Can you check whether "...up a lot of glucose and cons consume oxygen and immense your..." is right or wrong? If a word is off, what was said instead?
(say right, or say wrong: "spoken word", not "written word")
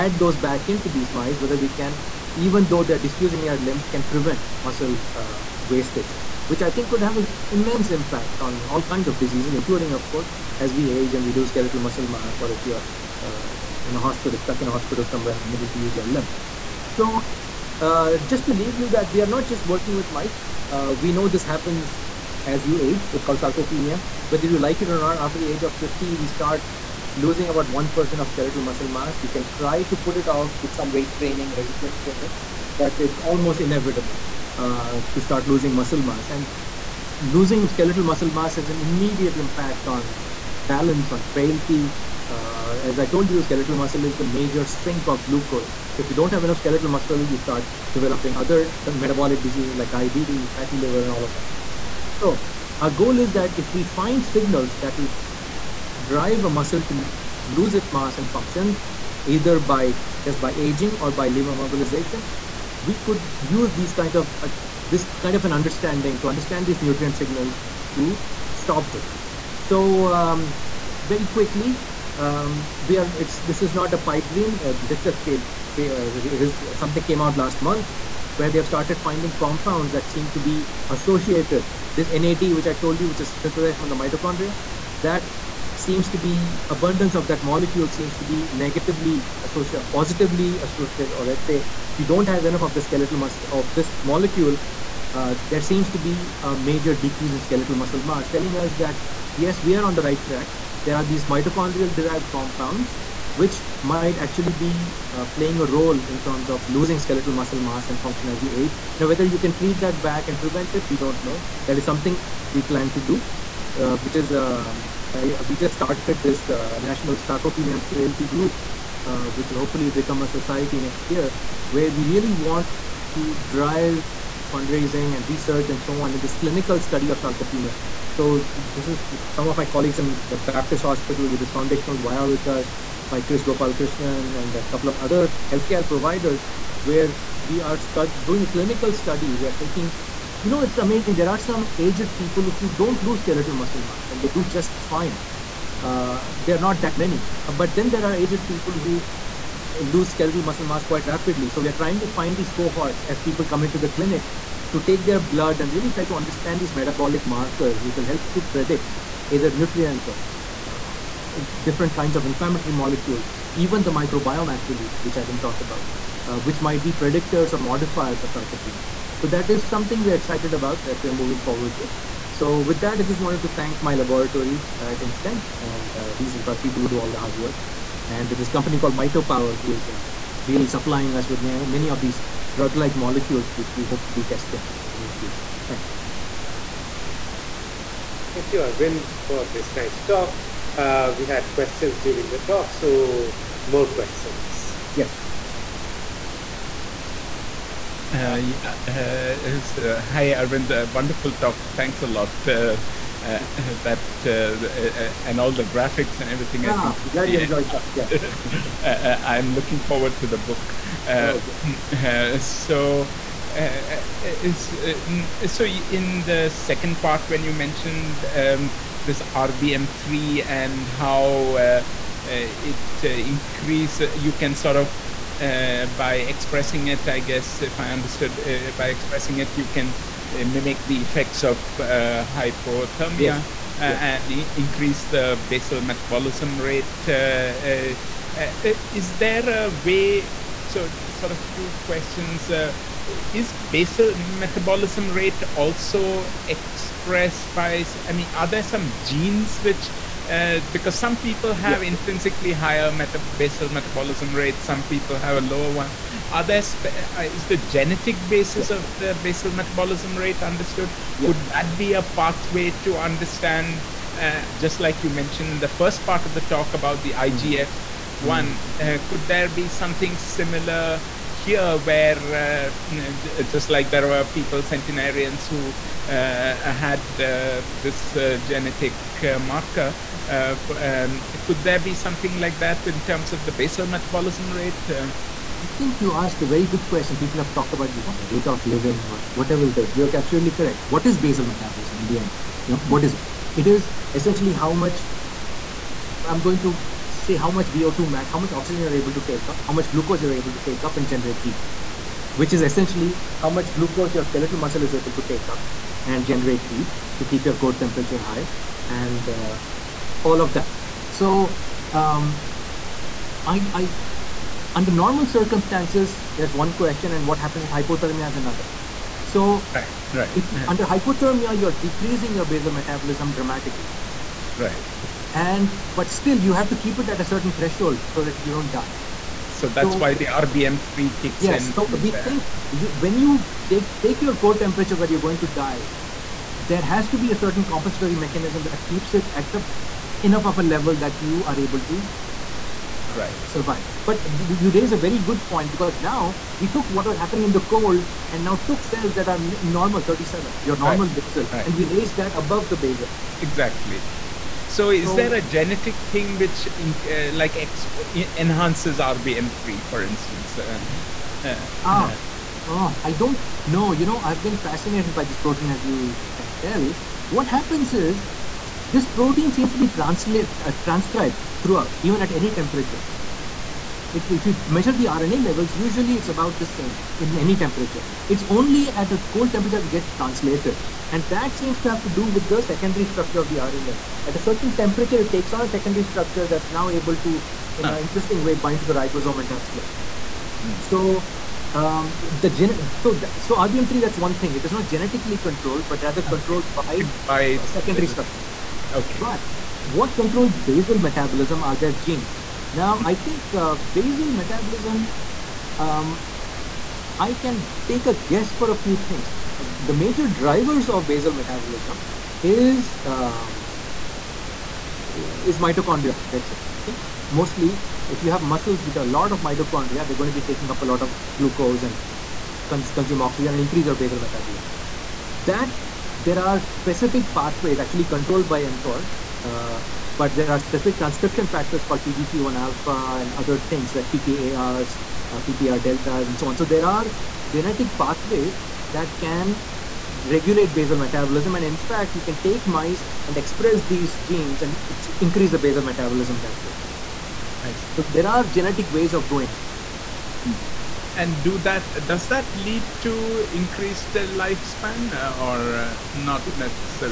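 wrong: "increase", not "immense".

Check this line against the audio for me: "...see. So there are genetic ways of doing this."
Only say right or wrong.
right.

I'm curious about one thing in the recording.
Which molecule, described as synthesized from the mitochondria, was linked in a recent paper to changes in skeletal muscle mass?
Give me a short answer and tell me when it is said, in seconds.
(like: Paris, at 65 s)
NAD, at 81 s.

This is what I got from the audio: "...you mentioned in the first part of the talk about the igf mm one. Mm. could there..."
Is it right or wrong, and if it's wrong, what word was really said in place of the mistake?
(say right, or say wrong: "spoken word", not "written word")
right.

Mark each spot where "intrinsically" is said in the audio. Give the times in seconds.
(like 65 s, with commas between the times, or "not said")
251 s.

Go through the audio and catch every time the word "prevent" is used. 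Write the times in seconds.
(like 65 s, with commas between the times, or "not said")
4 s, 110 s.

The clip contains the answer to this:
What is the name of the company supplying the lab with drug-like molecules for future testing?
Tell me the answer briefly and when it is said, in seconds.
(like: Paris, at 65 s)
MitoPower, at 178 s.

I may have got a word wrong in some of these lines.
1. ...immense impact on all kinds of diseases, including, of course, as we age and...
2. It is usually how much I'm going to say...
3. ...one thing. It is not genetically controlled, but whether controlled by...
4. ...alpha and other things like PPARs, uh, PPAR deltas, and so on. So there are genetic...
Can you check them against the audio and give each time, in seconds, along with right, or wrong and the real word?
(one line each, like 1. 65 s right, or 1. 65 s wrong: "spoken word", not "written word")
1. 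7 s right
2. 293 s wrong: "essentially", not "usually"
3. 394 s wrong: "rather", not "whether"
4. 432 s right.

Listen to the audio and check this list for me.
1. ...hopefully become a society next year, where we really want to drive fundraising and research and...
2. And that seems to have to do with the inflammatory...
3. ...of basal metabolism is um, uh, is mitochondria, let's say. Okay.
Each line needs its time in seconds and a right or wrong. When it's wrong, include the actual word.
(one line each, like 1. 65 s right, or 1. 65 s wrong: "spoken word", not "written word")
1. 119 s right
2. 381 s wrong: "secondary", not "inflammatory"
3. 410 s right.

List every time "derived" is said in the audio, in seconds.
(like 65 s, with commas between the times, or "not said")
101 s.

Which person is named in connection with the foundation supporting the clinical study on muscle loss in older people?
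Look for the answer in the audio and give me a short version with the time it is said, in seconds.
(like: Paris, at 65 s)
Kris Gopalakrishnan, at 133 s.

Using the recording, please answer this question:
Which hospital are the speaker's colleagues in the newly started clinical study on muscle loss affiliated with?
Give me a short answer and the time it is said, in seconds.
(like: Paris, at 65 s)
Baptist Hospital, at 130 s.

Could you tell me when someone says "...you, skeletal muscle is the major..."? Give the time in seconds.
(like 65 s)
43 s.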